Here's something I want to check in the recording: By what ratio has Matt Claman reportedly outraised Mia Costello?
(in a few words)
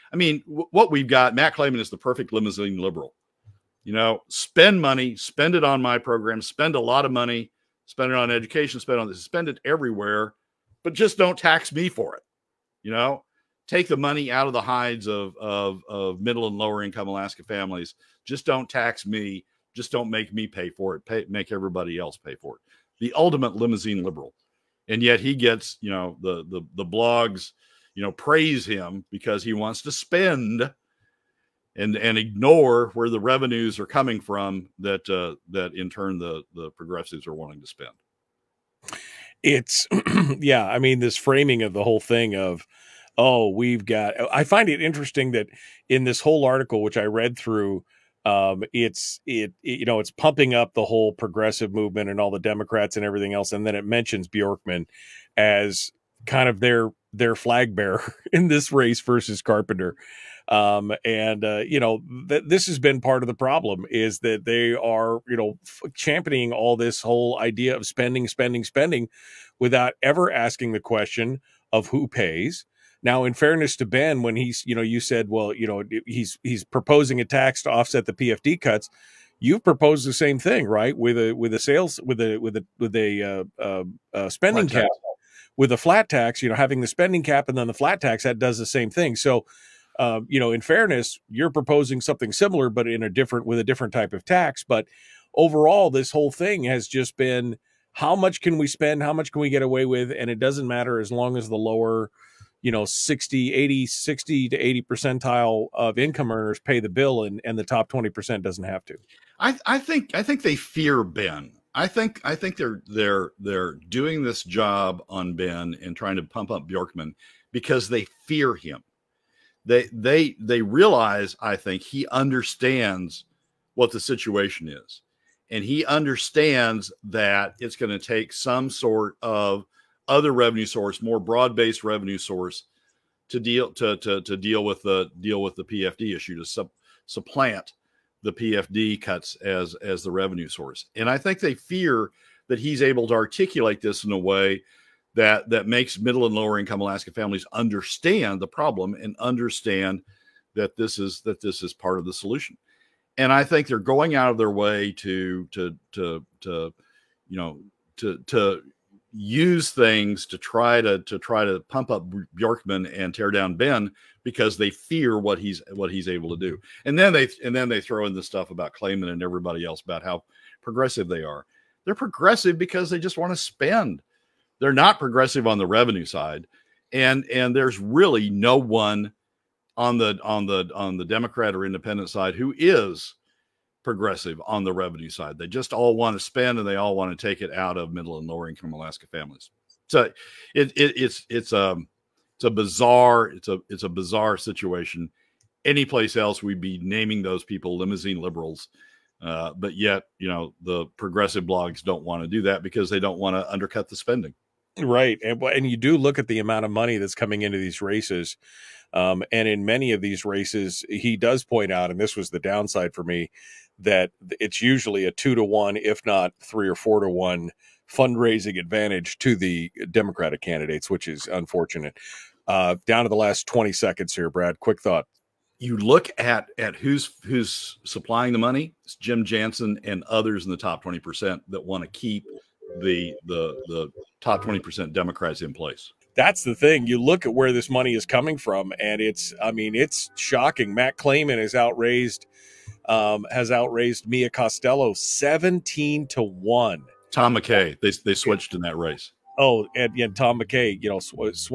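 17 to 1.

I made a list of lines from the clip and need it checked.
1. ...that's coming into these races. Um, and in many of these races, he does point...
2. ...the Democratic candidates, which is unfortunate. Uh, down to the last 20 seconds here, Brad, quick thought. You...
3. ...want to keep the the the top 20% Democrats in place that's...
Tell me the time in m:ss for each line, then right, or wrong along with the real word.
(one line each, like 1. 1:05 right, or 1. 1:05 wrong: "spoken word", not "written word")
1. 3:26 right
2. 3:39 right
3. 3:51 right.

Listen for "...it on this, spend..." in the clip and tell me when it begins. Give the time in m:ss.
0:08.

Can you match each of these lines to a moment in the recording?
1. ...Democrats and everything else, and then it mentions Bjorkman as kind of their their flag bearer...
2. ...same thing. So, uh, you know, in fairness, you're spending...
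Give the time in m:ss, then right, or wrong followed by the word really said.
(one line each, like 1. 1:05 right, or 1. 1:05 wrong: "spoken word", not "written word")
1. 0:52 right
2. 1:28 wrong: "proposing", not "spending".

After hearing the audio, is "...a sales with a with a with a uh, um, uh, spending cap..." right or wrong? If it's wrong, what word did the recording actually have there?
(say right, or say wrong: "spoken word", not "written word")
right.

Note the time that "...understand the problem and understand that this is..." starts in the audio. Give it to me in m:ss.
2:27.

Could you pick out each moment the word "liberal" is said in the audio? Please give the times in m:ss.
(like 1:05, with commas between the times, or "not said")
0:02, 0:24, 3:18.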